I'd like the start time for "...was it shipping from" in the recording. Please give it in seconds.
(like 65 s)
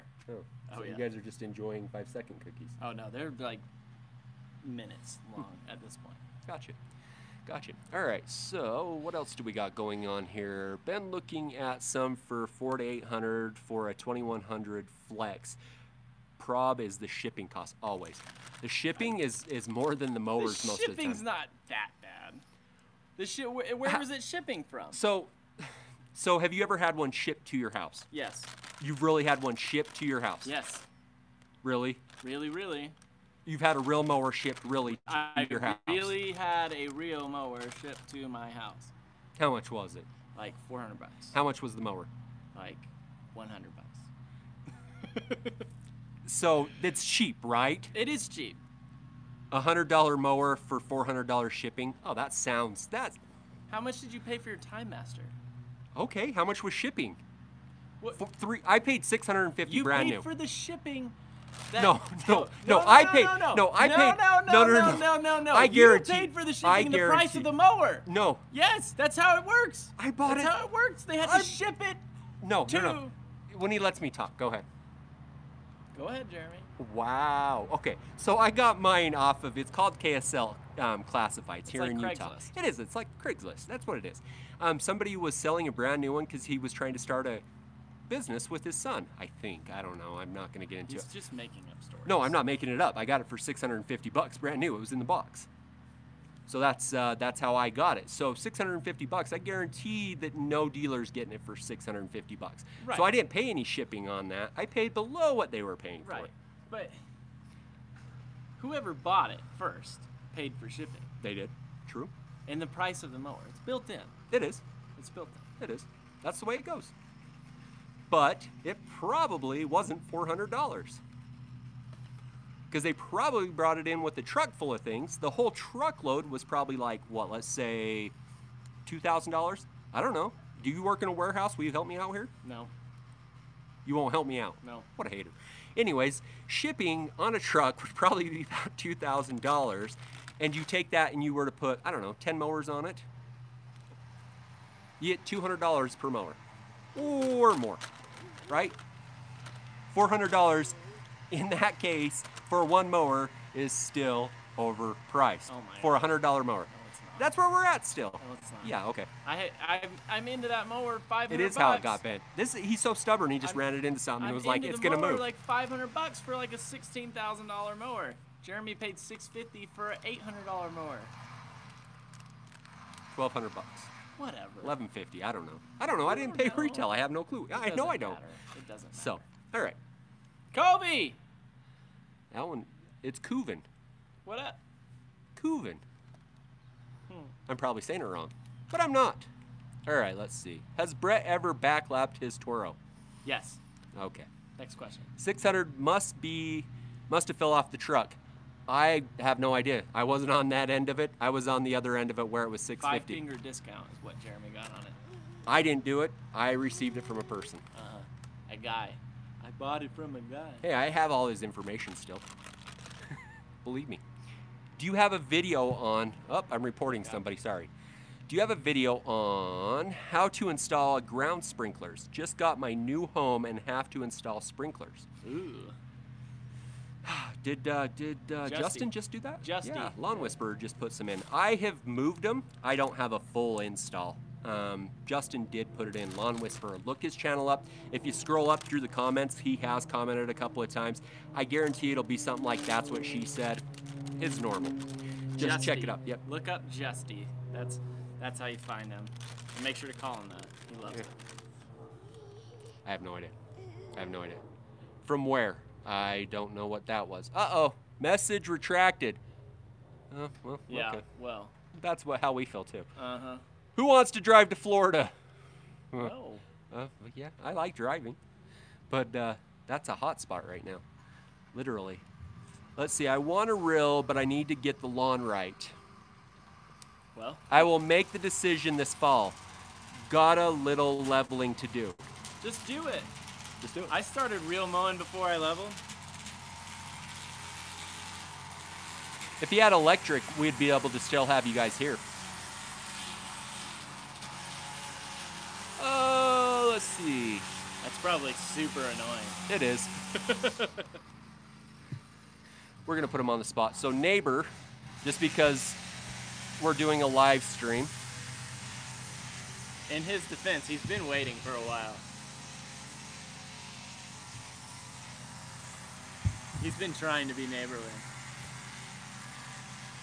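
23 s.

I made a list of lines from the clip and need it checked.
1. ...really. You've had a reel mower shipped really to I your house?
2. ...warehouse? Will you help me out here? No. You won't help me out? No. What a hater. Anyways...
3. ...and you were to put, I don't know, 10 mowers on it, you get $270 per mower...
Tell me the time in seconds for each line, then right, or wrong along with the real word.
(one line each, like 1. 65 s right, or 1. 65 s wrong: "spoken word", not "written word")
1. 32 s right
2. 131 s right
3. 141 s wrong: "200", not "270".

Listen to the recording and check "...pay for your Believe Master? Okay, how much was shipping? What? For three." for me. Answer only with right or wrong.
wrong.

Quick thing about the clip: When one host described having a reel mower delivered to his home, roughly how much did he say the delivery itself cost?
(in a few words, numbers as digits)
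$400.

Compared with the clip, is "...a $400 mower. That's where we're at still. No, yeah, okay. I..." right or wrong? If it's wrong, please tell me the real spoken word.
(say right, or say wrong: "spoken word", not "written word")
wrong: "100", not "400".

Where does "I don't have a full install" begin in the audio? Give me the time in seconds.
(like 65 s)
232 s.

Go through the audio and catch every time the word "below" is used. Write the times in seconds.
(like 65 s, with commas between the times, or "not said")
104 s.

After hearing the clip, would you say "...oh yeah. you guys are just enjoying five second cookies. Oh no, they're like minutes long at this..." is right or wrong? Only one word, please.
right.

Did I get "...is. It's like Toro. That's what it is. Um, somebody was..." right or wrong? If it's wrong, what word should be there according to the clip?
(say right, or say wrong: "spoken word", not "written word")
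wrong: "Craigslist", not "Toro".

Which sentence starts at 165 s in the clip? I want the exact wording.
Like five hundred bucks for like a sixteen thousand dollar mower.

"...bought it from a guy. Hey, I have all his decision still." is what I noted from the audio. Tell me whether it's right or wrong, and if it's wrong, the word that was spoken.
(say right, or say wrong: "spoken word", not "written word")
wrong: "information", not "decision".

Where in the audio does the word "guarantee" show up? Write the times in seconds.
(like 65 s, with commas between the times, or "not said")
65 s, 99 s, 241 s.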